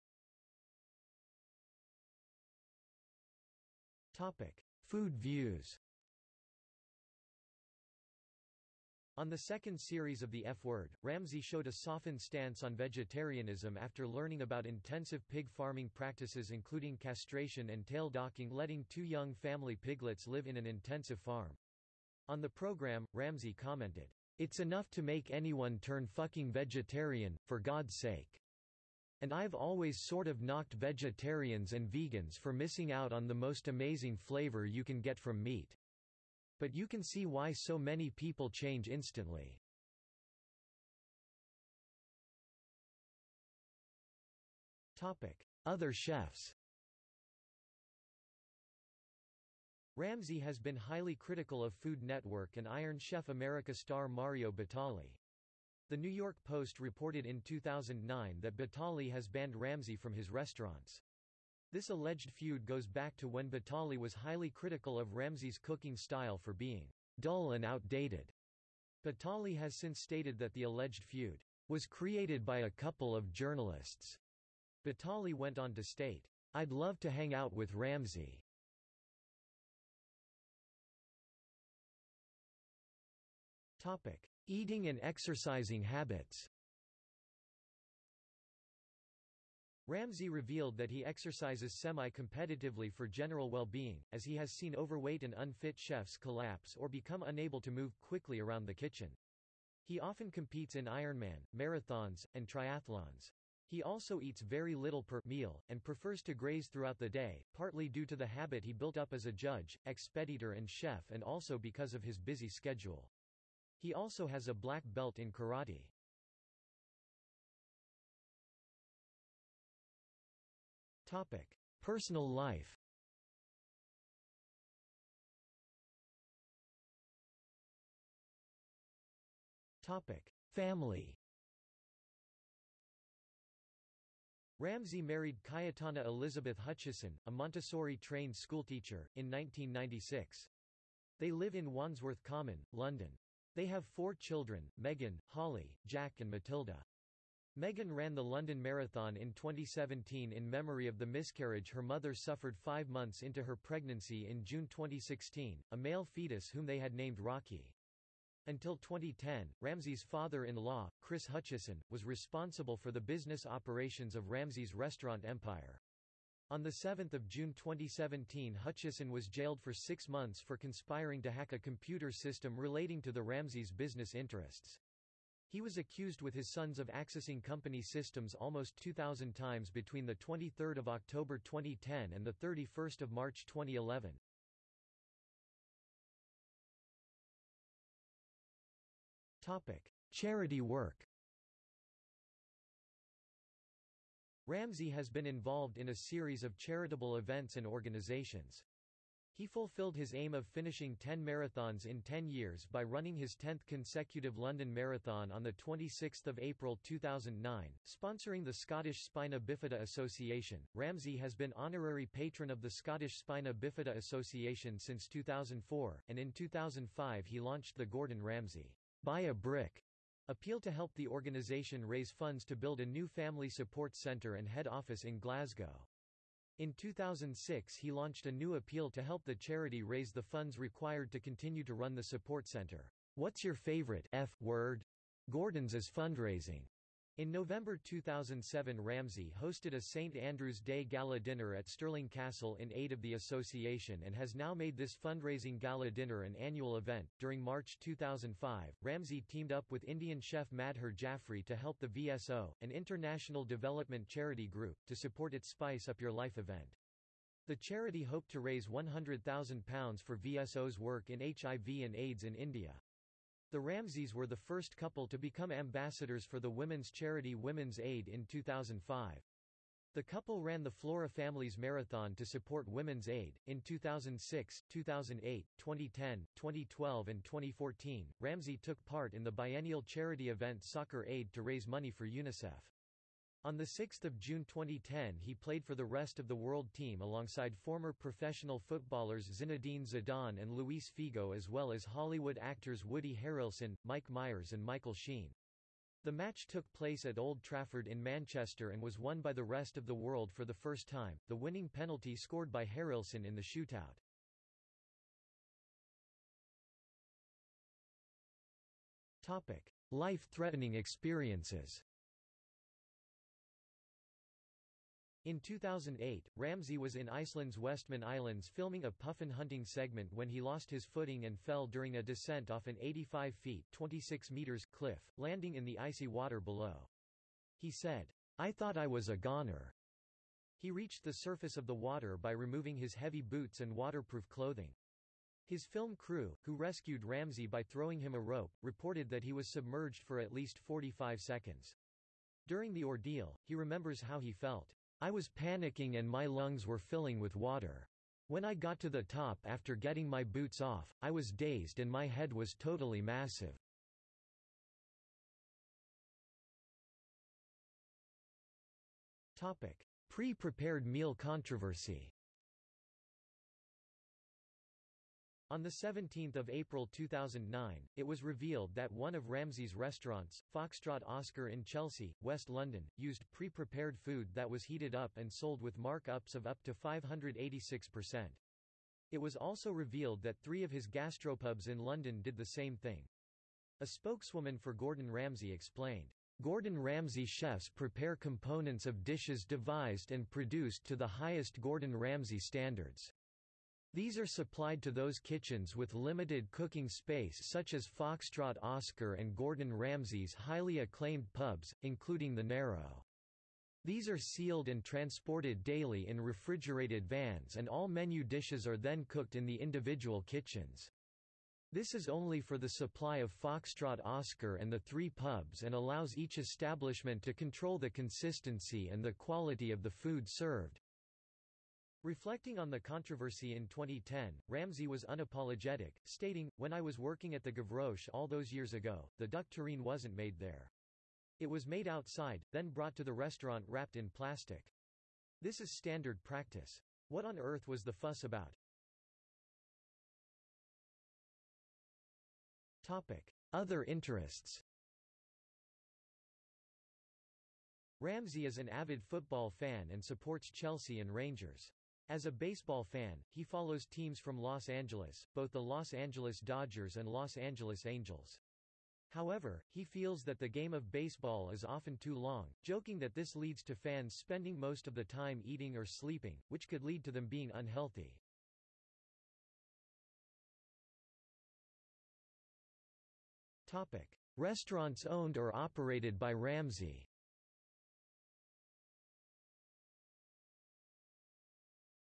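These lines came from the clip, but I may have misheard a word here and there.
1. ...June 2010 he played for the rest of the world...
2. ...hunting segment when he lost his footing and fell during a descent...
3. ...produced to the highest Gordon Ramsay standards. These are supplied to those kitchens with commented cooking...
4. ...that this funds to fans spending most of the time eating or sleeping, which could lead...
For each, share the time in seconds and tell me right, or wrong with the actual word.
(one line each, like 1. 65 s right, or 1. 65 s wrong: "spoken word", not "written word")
1. 284 s right
2. 319 s right
3. 390 s wrong: "limited", not "commented"
4. 462 s wrong: "leads", not "funds".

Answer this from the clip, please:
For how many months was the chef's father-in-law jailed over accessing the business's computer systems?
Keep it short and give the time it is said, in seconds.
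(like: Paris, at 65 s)
6, at 169 s.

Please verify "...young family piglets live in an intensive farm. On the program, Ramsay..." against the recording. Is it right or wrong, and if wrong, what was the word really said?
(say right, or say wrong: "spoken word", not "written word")
right.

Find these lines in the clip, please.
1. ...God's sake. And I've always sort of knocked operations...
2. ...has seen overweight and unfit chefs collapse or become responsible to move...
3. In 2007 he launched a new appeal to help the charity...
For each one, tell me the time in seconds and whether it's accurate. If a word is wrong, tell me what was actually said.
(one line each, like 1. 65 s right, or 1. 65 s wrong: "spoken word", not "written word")
1. 27 s wrong: "vegetarians", not "operations"
2. 94 s wrong: "unable", not "responsible"
3. 226 s wrong: "2006", not "2007".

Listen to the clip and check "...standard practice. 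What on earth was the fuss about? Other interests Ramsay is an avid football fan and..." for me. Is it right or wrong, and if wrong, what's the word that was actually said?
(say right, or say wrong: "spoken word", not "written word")
right.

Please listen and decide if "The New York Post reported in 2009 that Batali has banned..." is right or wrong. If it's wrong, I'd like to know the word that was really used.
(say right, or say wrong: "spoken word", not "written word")
right.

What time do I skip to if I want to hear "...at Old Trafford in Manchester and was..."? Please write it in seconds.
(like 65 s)
297 s.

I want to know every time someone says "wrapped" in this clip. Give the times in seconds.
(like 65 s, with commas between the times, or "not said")
433 s.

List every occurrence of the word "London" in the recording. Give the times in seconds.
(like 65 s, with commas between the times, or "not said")
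142 s, 148 s, 204 s, 372 s, 381 s.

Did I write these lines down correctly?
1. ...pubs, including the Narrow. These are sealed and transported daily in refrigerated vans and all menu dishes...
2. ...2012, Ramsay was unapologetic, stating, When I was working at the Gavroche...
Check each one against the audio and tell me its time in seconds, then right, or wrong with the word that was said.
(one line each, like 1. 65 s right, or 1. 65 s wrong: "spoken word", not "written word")
1. 401 s right
2. 423 s wrong: "2010", not "2012".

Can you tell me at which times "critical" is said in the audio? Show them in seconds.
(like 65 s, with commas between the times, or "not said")
51 s, 64 s.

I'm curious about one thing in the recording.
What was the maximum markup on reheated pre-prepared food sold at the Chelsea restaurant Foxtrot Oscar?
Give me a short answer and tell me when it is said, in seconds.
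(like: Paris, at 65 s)
586%, at 376 s.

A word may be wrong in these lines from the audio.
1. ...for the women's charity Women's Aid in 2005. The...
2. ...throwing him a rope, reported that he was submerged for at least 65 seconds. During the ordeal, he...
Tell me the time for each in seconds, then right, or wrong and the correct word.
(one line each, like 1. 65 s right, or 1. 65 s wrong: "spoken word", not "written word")
1. 266 s right
2. 337 s wrong: "45", not "65".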